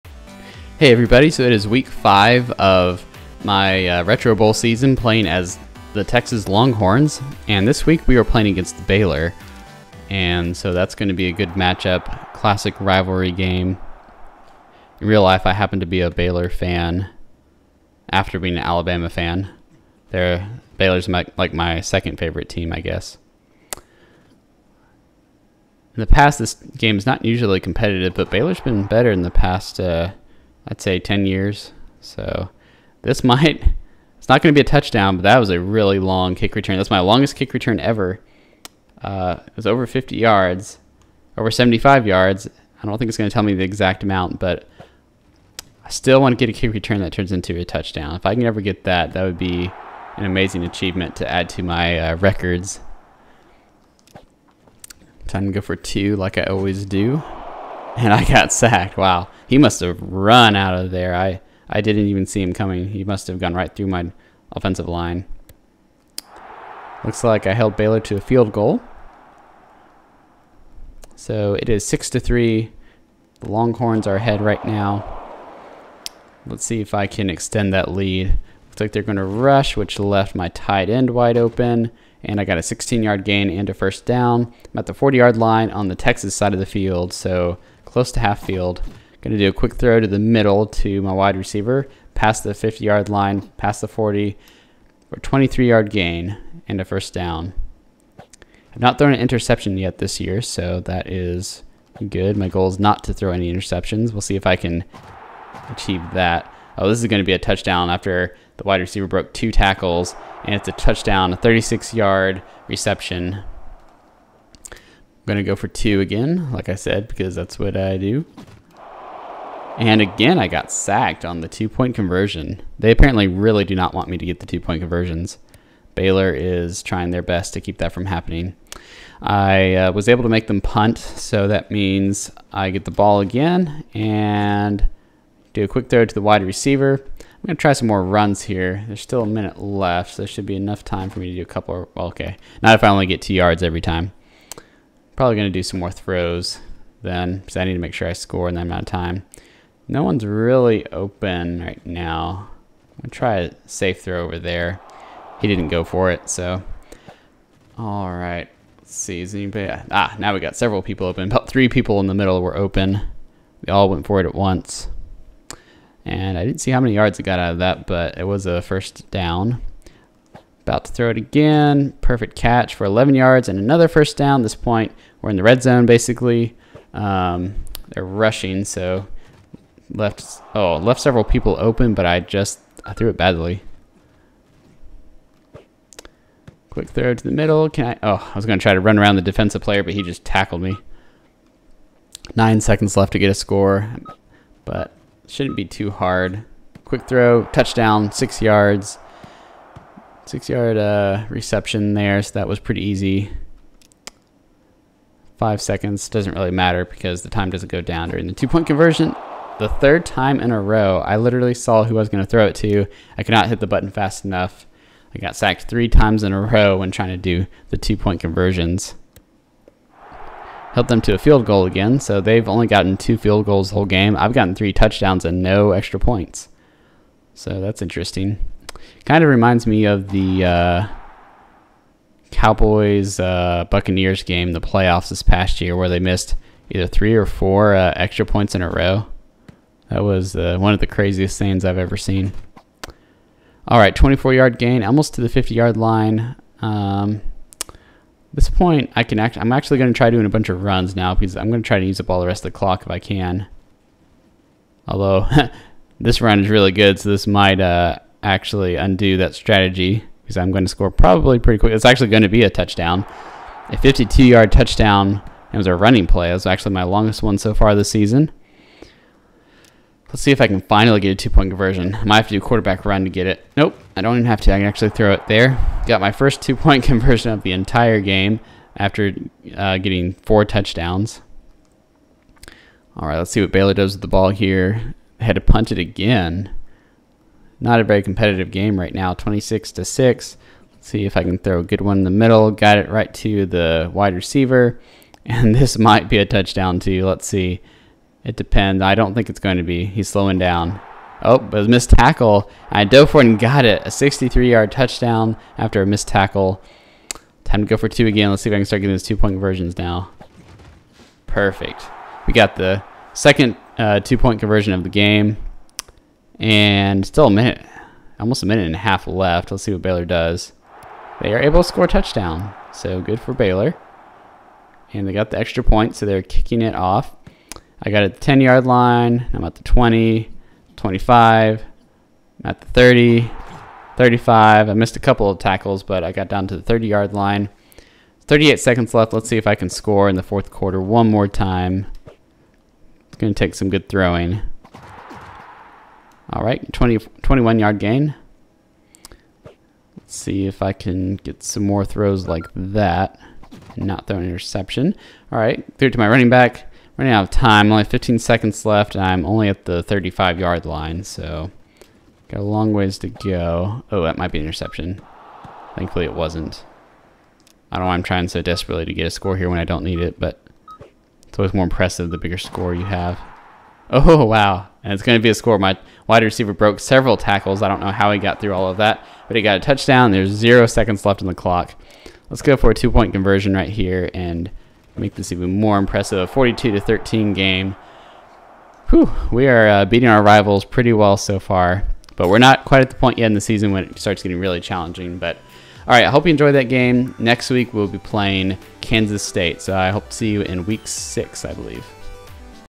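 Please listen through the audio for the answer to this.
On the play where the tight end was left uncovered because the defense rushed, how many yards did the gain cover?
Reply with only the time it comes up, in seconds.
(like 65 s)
82 s.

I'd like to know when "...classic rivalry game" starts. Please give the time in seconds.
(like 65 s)
12 s.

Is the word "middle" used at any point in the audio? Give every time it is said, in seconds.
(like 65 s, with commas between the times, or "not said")
90 s, 162 s, 187 s, 292 s.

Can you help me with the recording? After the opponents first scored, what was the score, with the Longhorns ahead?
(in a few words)
6 to 3.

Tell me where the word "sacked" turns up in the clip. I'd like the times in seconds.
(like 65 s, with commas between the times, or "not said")
58 s, 120 s, 215 s.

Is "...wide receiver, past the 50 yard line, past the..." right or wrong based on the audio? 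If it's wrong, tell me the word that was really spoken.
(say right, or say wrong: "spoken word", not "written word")
right.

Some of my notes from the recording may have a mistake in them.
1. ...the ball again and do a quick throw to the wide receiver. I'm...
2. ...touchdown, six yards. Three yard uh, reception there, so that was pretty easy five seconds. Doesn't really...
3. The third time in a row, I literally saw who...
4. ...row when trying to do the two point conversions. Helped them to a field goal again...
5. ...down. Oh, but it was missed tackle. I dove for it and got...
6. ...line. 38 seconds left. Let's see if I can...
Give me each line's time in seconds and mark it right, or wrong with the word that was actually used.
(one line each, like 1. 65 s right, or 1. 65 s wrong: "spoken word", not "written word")
1. 132 s right
2. 197 s wrong: "Six", not "Three"
3. 209 s right
4. 216 s right
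5. 300 s right
6. 337 s right.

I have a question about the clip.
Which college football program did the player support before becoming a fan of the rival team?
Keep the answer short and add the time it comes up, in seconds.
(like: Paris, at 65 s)
Alabama, at 18 s.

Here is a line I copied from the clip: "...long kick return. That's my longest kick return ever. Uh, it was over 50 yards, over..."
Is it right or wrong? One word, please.
right.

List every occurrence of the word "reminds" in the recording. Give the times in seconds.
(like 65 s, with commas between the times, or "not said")
229 s.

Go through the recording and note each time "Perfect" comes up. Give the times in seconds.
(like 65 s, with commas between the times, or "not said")
172 s, 311 s.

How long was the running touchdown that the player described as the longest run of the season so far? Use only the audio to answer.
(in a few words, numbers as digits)
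52 yards.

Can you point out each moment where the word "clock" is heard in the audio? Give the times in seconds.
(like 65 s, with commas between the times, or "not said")
252 s, 381 s.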